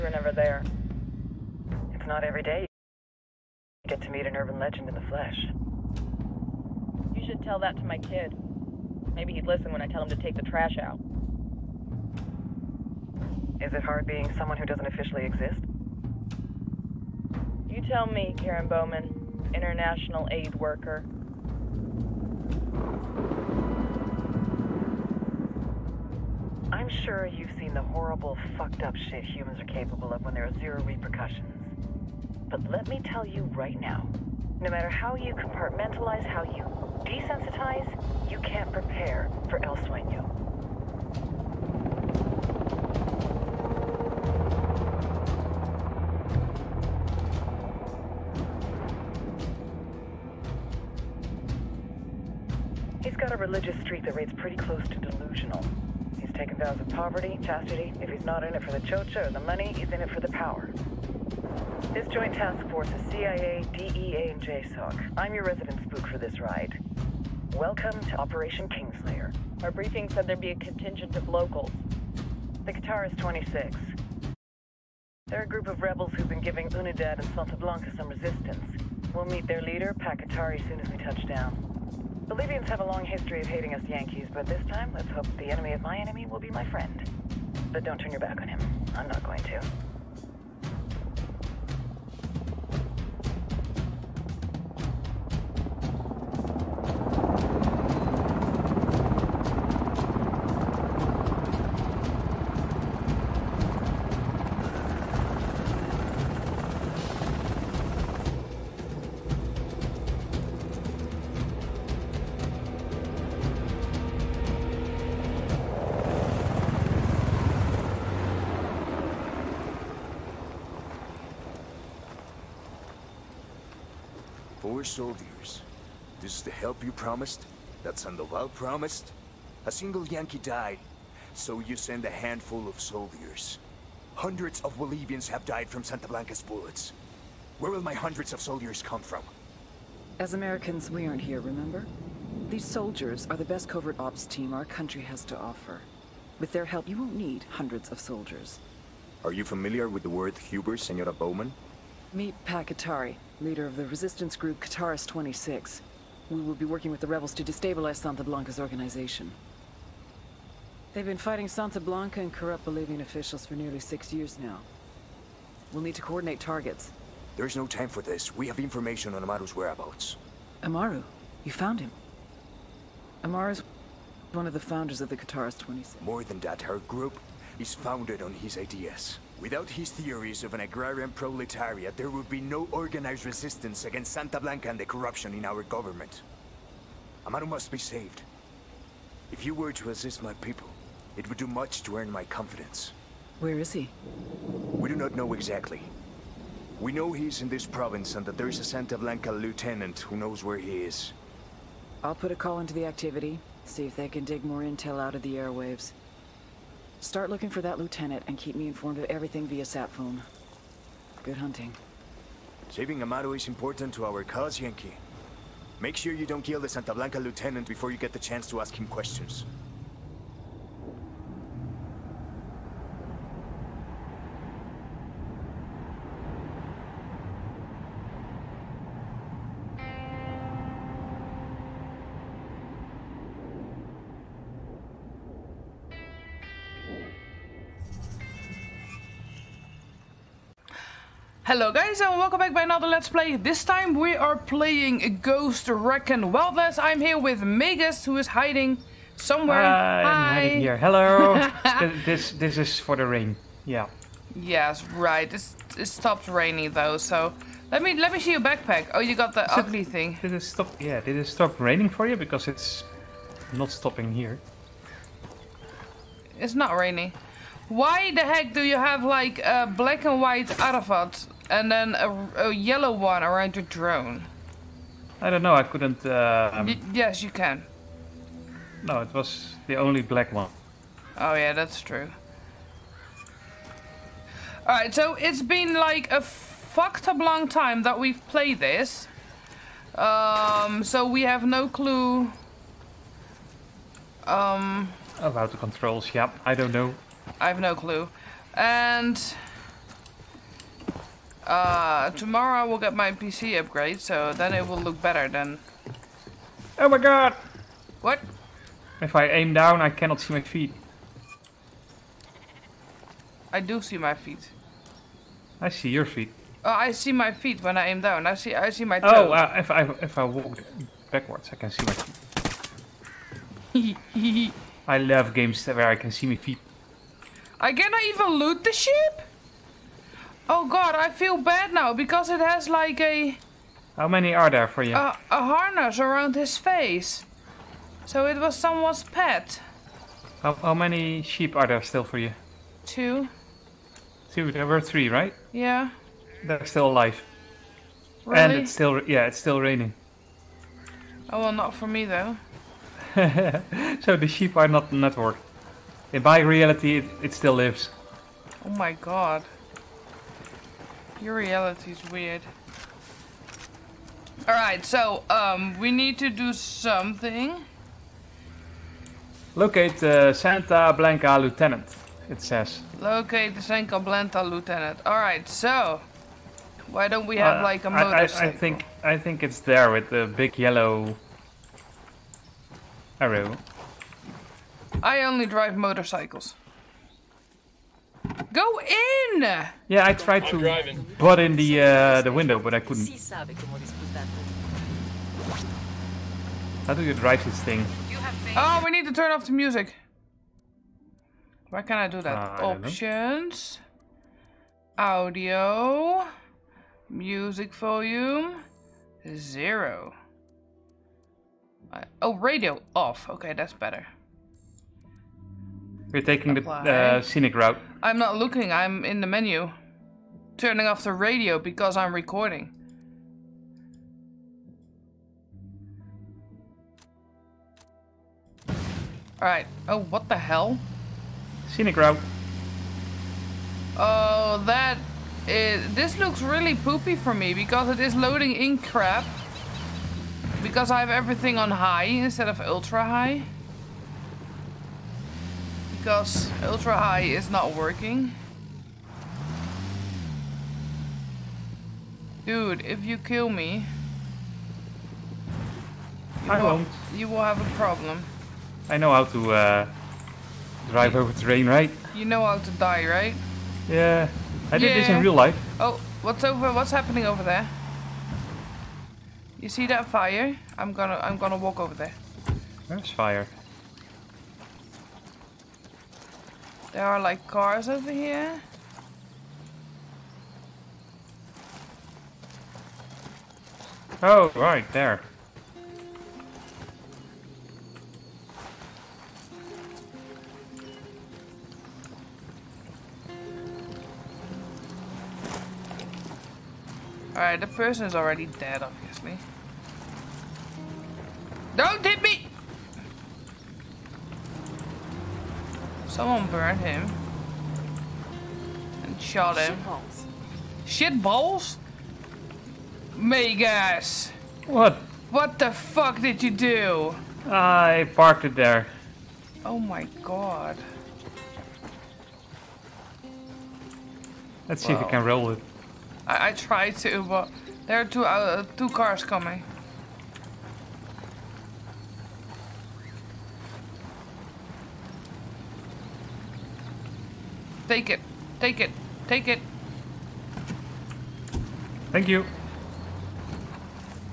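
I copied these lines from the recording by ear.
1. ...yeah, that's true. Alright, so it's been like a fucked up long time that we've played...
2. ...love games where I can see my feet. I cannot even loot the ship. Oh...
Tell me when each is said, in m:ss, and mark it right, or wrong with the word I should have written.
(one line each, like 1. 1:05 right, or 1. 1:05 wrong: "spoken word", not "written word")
1. 4:41 right
2. 5:24 right.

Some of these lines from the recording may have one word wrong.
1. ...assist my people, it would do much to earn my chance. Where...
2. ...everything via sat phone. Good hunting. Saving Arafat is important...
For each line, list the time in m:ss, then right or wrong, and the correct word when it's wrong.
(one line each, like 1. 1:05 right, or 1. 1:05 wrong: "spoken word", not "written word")
1. 3:09 wrong: "confidence", not "chance"
2. 3:29 wrong: "Amaru", not "Arafat".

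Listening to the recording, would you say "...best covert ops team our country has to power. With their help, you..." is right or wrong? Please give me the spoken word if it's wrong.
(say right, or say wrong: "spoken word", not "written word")
wrong: "offer", not "power".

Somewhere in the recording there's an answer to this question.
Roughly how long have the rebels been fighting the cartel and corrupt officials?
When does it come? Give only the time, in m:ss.
2:43.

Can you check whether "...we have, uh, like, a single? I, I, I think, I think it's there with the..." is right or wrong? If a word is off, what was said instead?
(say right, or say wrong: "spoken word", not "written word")
wrong: "motorcycle", not "single".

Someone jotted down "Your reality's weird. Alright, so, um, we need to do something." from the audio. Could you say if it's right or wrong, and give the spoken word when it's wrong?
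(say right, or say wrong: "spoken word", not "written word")
right.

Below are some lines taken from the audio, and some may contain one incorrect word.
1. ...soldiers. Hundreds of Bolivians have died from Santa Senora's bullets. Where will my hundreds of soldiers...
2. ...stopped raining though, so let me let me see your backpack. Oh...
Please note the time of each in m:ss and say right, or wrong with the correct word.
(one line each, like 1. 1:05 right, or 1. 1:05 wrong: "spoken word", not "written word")
1. 2:12 wrong: "Blanca", not "Senora"
2. 4:15 right.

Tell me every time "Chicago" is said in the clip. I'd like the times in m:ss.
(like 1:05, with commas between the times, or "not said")
not said.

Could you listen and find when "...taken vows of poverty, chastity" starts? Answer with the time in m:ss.
0:56.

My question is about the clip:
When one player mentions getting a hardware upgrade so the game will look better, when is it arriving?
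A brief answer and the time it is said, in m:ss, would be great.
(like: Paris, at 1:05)
tomorrow, at 5:02.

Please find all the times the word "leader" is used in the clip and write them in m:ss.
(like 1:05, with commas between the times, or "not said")
1:19, 2:33.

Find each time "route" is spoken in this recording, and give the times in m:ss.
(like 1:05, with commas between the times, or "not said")
6:57, 7:11.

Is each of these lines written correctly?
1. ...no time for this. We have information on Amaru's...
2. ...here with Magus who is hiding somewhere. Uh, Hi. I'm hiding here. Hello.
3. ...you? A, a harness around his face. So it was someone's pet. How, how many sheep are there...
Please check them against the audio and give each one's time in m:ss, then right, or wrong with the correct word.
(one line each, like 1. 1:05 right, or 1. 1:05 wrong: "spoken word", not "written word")
1. 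2:47 right
2. 4:06 right
3. 5:34 right.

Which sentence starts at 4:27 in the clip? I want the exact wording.
Why the heck do you have like a black and white Arafat and then a, a yellow one around your drone.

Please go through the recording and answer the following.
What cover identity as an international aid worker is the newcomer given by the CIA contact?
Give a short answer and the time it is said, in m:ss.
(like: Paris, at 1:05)
Karen Bowman, at 0:18.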